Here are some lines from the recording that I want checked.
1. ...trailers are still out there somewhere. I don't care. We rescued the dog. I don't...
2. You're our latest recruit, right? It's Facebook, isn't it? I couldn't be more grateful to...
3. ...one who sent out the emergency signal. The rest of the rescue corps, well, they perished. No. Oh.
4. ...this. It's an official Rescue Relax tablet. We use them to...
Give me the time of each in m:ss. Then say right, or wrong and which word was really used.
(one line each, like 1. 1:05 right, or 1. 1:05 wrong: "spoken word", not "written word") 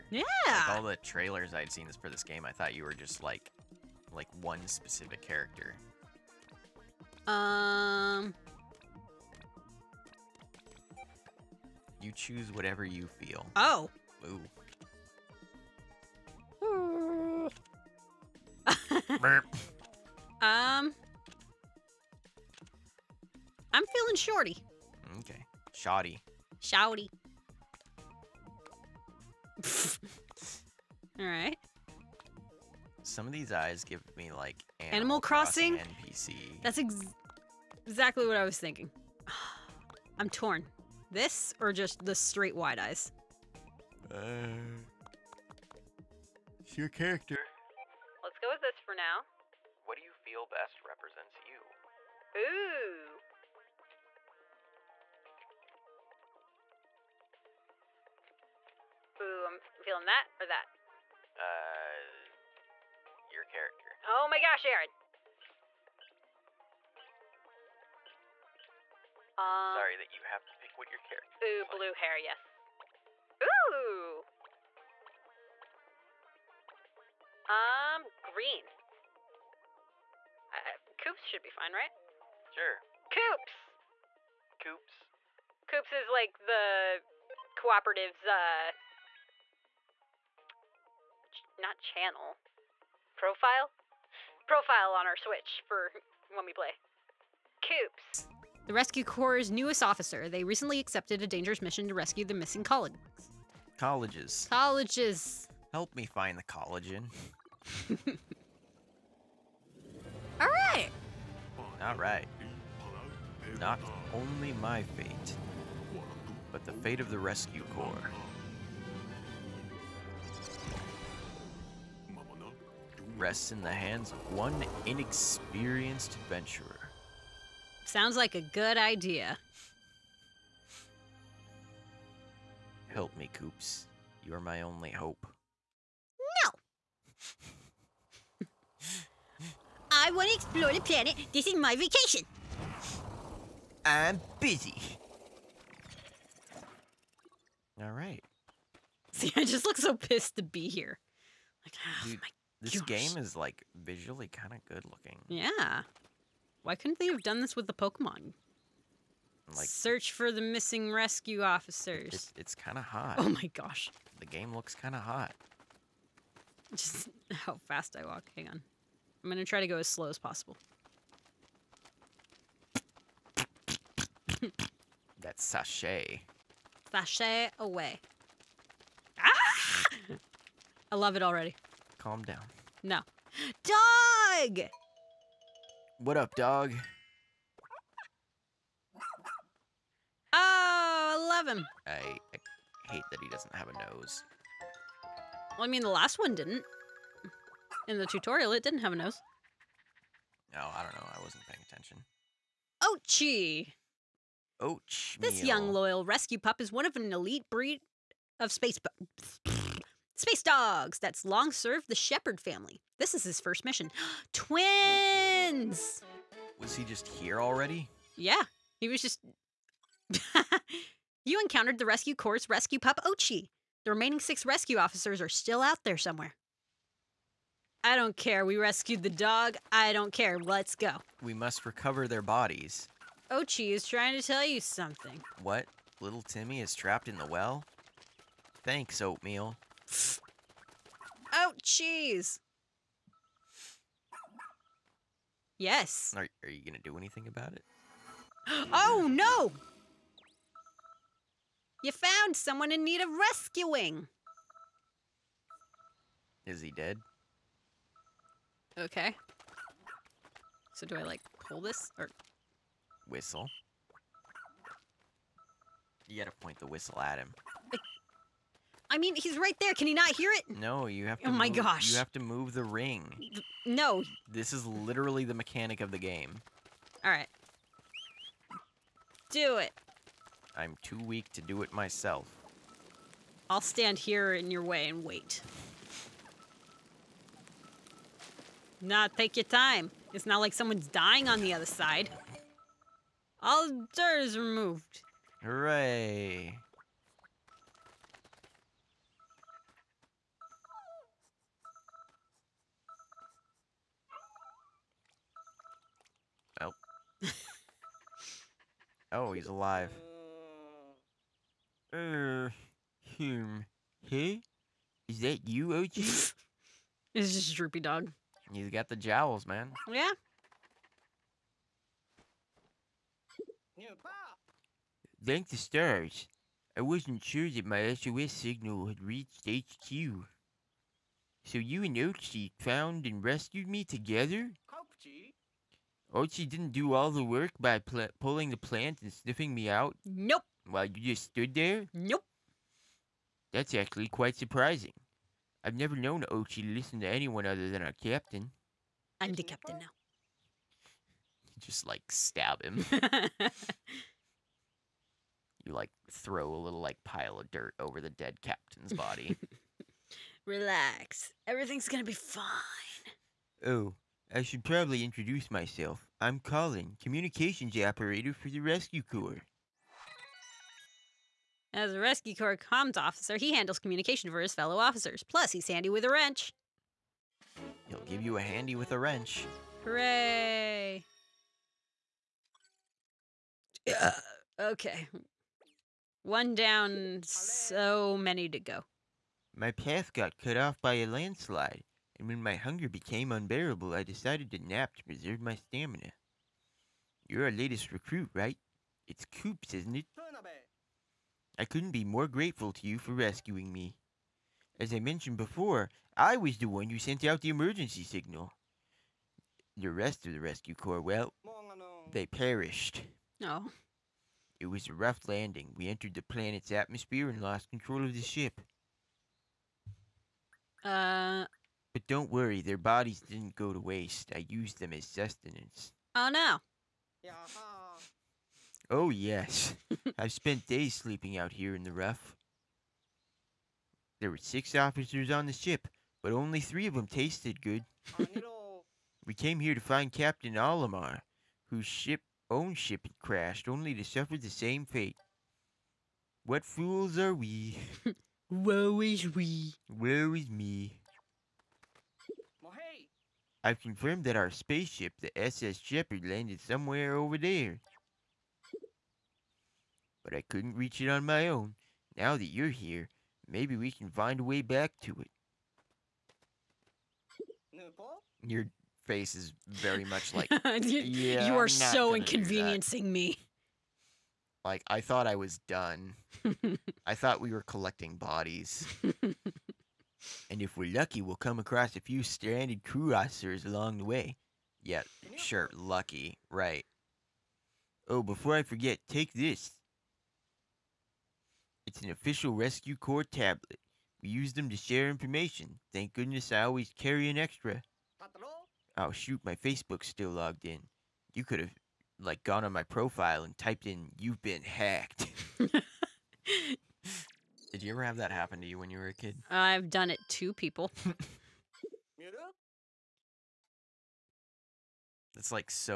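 1. 3:44 wrong: "officers", not "trailers"
2. 6:37 wrong: "Coops", not "Facebook"
3. 6:46 right
4. 8:09 wrong: "Corps", not "Relax".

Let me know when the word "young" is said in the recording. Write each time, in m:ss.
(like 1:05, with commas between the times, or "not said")
3:25.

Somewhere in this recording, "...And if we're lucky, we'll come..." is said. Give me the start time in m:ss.
8:00.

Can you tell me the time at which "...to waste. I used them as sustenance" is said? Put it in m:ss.
7:03.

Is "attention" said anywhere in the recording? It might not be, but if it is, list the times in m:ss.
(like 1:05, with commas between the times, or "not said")
3:21.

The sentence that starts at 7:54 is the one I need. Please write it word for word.
Like, I thought I was done.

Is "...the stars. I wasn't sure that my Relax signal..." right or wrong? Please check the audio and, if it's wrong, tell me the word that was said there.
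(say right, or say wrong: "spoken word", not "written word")
wrong: "SOS", not "Relax".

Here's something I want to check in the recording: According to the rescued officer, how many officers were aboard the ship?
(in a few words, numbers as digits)
6.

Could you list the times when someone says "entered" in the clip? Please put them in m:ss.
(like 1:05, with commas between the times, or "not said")
6:55.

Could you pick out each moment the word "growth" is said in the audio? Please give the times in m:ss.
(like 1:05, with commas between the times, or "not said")
not said.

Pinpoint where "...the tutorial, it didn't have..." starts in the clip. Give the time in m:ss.
3:17.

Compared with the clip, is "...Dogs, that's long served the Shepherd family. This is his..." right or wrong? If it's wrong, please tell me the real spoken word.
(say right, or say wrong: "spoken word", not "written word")
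right.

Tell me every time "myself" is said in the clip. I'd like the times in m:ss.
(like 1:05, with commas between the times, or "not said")
4:41, 6:05.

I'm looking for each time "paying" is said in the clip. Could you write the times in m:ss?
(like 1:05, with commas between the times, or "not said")
3:21.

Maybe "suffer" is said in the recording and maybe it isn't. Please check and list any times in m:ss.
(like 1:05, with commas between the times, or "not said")
7:24.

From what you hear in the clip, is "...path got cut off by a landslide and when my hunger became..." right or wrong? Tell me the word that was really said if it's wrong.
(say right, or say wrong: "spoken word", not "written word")
right.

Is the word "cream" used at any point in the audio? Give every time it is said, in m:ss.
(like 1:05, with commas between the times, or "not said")
not said.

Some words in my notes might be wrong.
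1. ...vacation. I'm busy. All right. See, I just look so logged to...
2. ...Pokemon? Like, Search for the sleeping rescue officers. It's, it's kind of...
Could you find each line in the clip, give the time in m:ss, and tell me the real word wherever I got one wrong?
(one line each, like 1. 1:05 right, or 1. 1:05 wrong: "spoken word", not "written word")
1. 2:21 wrong: "pissed", not "logged"
2. 2:37 wrong: "missing", not "sleeping".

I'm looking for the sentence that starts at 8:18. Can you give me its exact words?
Oh shoot, my Facebook's still logged in.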